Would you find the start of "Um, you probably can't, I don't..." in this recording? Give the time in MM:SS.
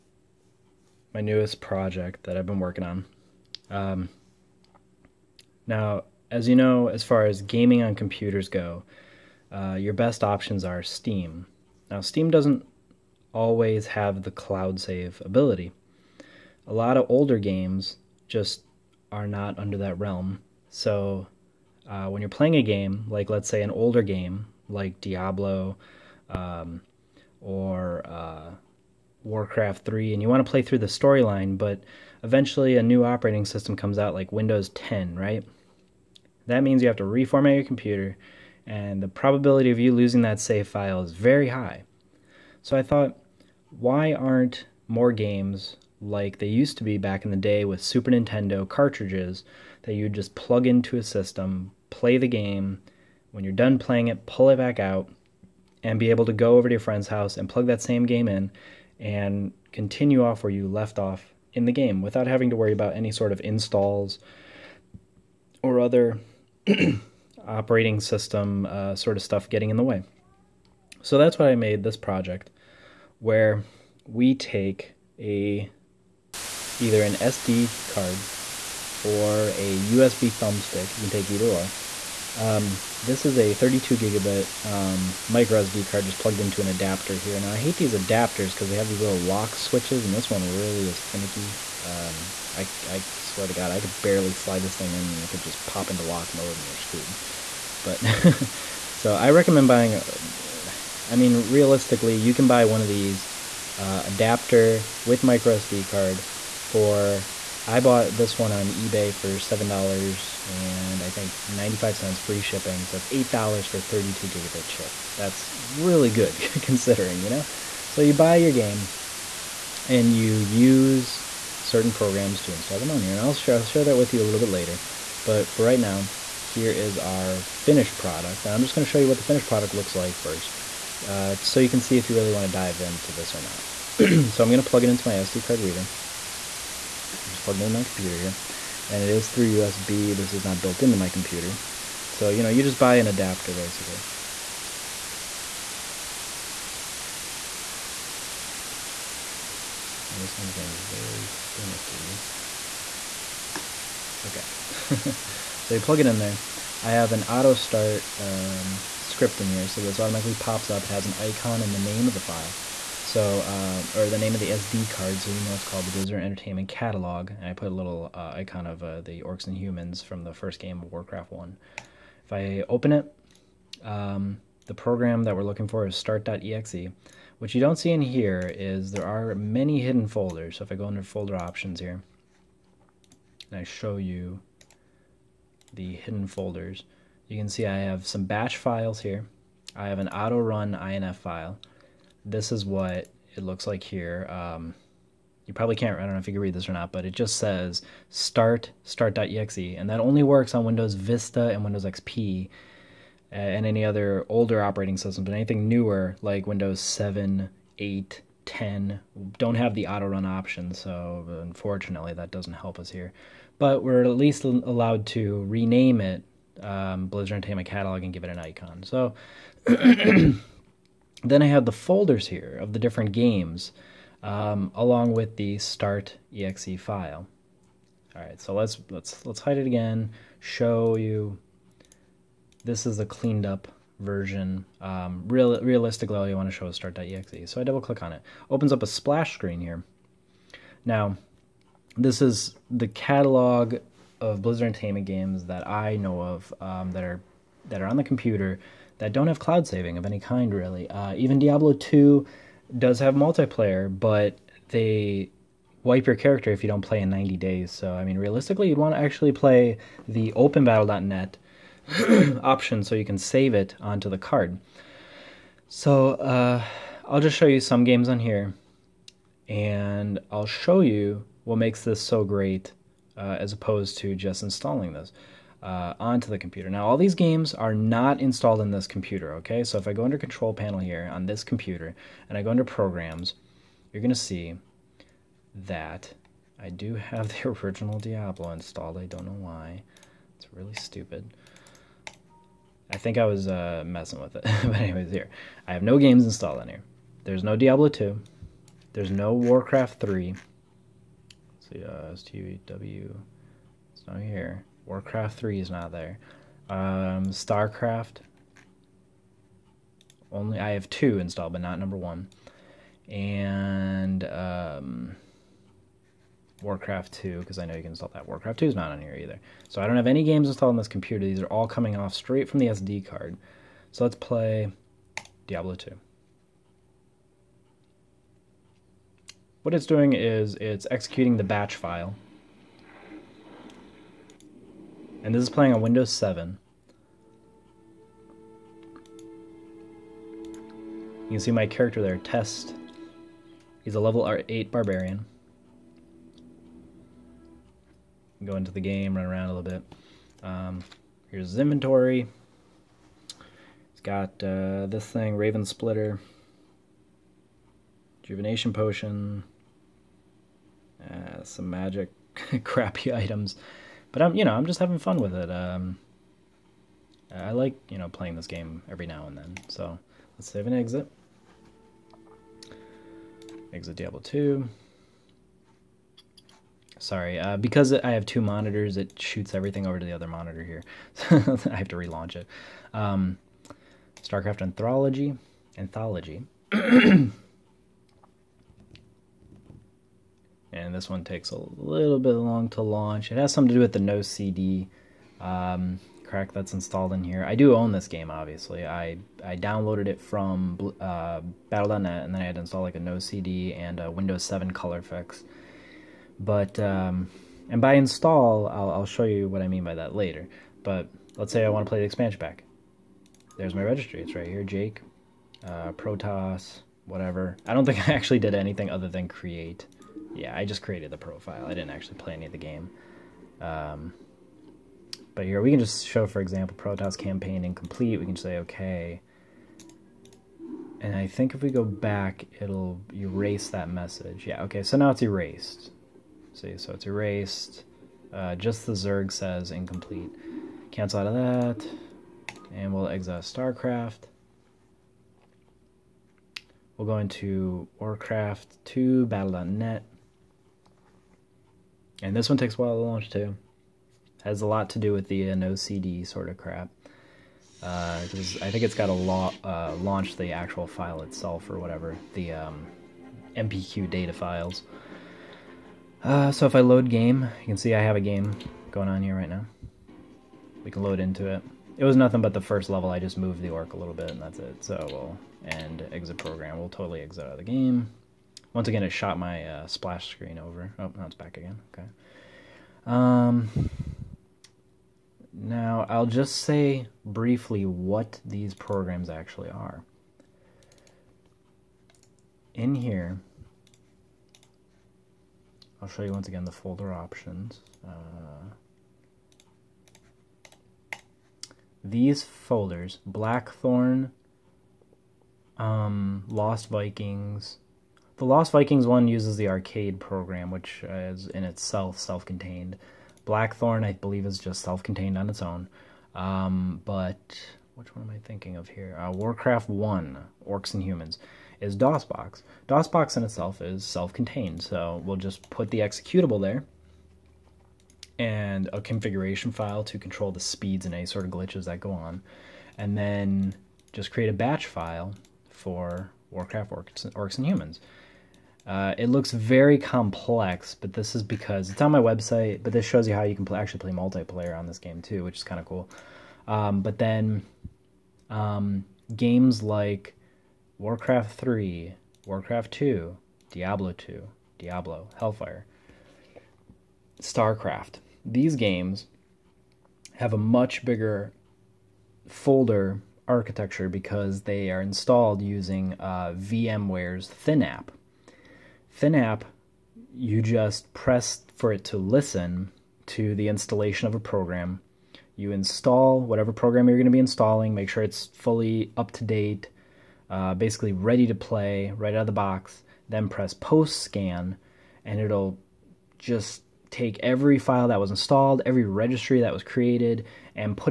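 03:14.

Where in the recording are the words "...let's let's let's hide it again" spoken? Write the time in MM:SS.
03:48.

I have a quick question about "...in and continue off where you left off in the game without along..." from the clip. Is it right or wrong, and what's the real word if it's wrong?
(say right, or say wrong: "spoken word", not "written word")
wrong: "having", not "along".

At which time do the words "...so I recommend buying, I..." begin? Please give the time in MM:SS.
01:38.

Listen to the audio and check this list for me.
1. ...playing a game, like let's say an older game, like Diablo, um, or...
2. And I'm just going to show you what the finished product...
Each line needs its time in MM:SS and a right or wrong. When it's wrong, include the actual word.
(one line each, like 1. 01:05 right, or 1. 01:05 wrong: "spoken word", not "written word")
1. 00:22 right
2. 02:08 right.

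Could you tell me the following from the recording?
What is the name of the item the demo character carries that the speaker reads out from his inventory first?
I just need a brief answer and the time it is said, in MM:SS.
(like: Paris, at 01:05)
Raven Splitter, at 05:55.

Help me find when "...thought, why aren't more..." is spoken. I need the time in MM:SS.
00:42.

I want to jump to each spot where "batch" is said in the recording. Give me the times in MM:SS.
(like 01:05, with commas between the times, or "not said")
03:08, 05:31, 08:54.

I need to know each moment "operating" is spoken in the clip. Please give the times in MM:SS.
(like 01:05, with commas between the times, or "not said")
00:33, 01:07, 03:24.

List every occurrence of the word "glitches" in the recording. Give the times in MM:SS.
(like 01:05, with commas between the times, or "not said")
08:51.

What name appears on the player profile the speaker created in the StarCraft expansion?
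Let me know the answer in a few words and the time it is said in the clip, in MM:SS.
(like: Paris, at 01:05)
Jake, at 06:54.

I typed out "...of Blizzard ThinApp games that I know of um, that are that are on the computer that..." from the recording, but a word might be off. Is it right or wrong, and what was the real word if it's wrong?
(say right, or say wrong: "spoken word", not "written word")
wrong: "Entertainment", not "ThinApp".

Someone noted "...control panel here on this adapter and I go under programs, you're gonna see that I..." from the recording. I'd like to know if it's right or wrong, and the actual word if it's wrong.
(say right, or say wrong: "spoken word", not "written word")
wrong: "computer", not "adapter".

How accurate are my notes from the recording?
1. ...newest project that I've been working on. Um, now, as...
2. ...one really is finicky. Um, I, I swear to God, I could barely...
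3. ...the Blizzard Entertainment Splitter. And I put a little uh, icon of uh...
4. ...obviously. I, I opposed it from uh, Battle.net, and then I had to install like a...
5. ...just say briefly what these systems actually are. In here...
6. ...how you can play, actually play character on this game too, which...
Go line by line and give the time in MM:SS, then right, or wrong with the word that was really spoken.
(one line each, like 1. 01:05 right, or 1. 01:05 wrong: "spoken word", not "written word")
1. 00:01 right
2. 01:30 right
3. 02:45 wrong: "Catalog", not "Splitter"
4. 06:38 wrong: "downloaded", not "opposed"
5. 08:06 wrong: "programs", not "systems"
6. 09:03 wrong: "multiplayer", not "character".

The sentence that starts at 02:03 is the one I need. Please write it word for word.
And I'll share, I'll share that with you a little bit later.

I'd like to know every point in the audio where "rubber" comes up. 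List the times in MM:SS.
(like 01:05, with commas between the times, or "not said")
not said.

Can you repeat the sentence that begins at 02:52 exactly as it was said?
If I open it, um, the program that we're looking for is start.exe.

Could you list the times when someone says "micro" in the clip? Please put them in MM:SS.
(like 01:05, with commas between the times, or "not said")
01:25, 01:45.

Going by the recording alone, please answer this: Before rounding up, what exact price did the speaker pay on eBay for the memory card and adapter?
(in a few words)
$7.95.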